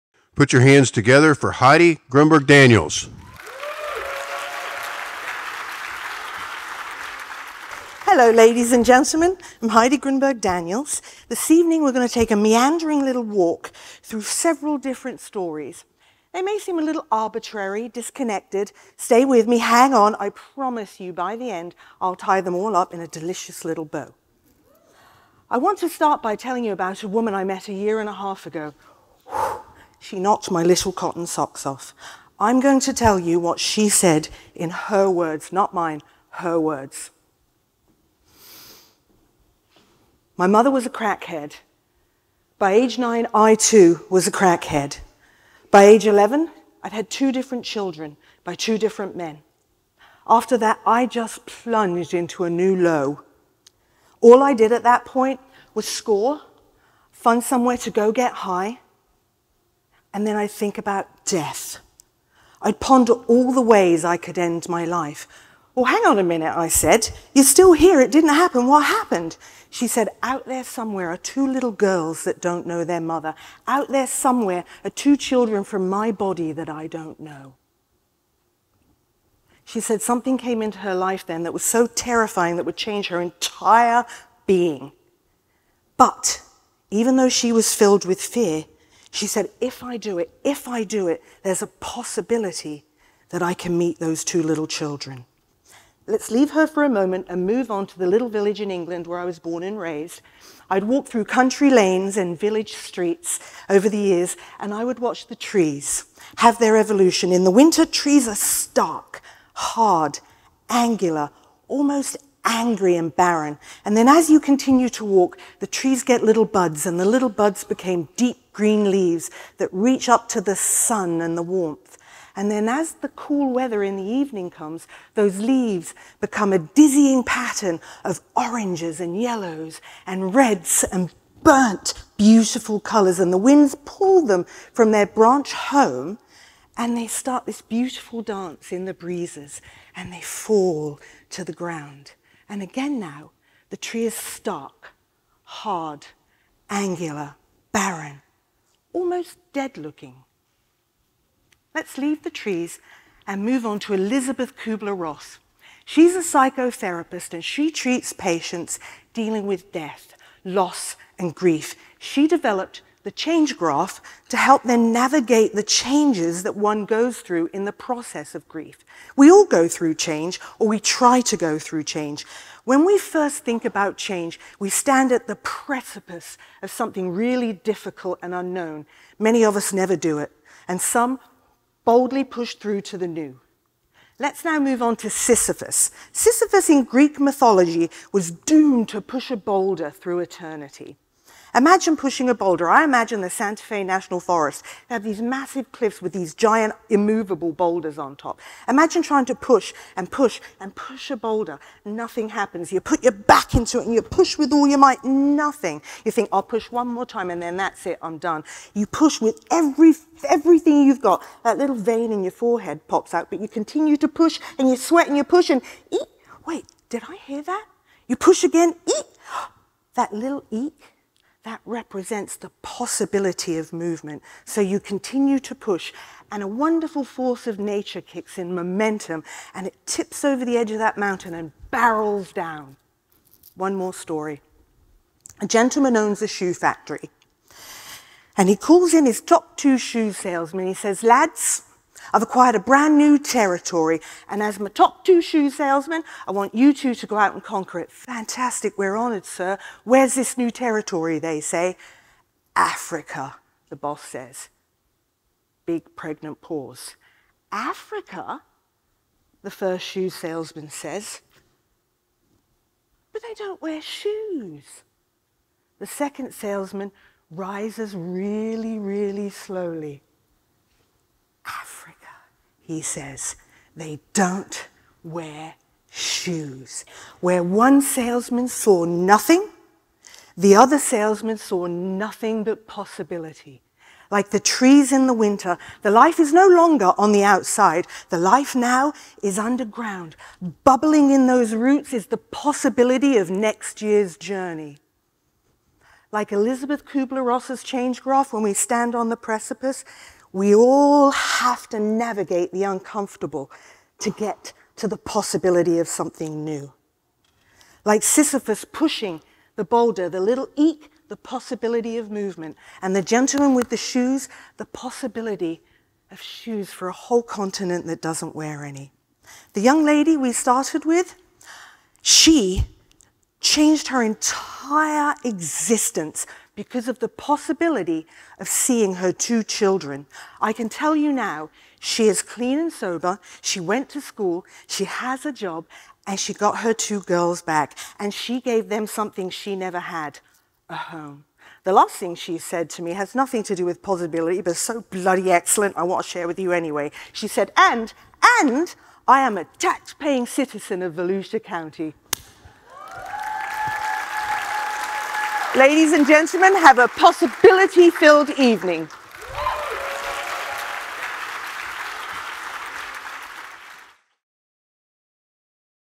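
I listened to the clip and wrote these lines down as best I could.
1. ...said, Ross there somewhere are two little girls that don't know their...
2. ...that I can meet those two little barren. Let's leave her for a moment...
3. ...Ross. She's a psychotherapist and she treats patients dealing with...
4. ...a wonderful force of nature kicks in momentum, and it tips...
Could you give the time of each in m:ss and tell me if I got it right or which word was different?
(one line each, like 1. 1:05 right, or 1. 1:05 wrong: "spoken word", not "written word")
1. 1:09 wrong: "Out", not "Ross"
2. 1:33 wrong: "children", not "barren"
3. 2:34 right
4. 3:46 right.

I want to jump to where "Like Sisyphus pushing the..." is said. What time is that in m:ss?
5:07.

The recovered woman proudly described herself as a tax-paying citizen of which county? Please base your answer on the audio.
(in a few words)
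Volusia County.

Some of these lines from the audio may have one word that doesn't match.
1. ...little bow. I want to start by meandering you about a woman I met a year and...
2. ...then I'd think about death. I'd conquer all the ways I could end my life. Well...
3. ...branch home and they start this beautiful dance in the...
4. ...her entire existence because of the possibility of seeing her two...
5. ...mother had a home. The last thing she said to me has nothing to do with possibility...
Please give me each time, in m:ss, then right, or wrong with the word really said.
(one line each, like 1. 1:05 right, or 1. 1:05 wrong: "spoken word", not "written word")
1. 0:23 wrong: "telling", not "meandering"
2. 1:00 wrong: "ponder", not "conquer"
3. 2:15 right
4. 5:23 right
5. 5:39 wrong: "never", not "mother".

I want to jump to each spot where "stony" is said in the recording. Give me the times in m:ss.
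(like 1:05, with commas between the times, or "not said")
not said.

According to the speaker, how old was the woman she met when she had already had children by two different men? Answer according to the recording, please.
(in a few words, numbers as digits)
11.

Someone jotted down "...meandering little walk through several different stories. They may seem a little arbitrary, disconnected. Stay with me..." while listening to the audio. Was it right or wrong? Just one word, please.
right.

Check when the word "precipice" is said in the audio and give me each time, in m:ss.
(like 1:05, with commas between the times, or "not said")
2:55, 4:59.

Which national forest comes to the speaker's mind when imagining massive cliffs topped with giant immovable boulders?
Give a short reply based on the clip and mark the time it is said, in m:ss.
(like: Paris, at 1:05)
Santa Fe National Forest, at 3:13.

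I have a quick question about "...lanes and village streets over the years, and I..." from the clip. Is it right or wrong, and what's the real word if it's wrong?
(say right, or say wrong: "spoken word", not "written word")
right.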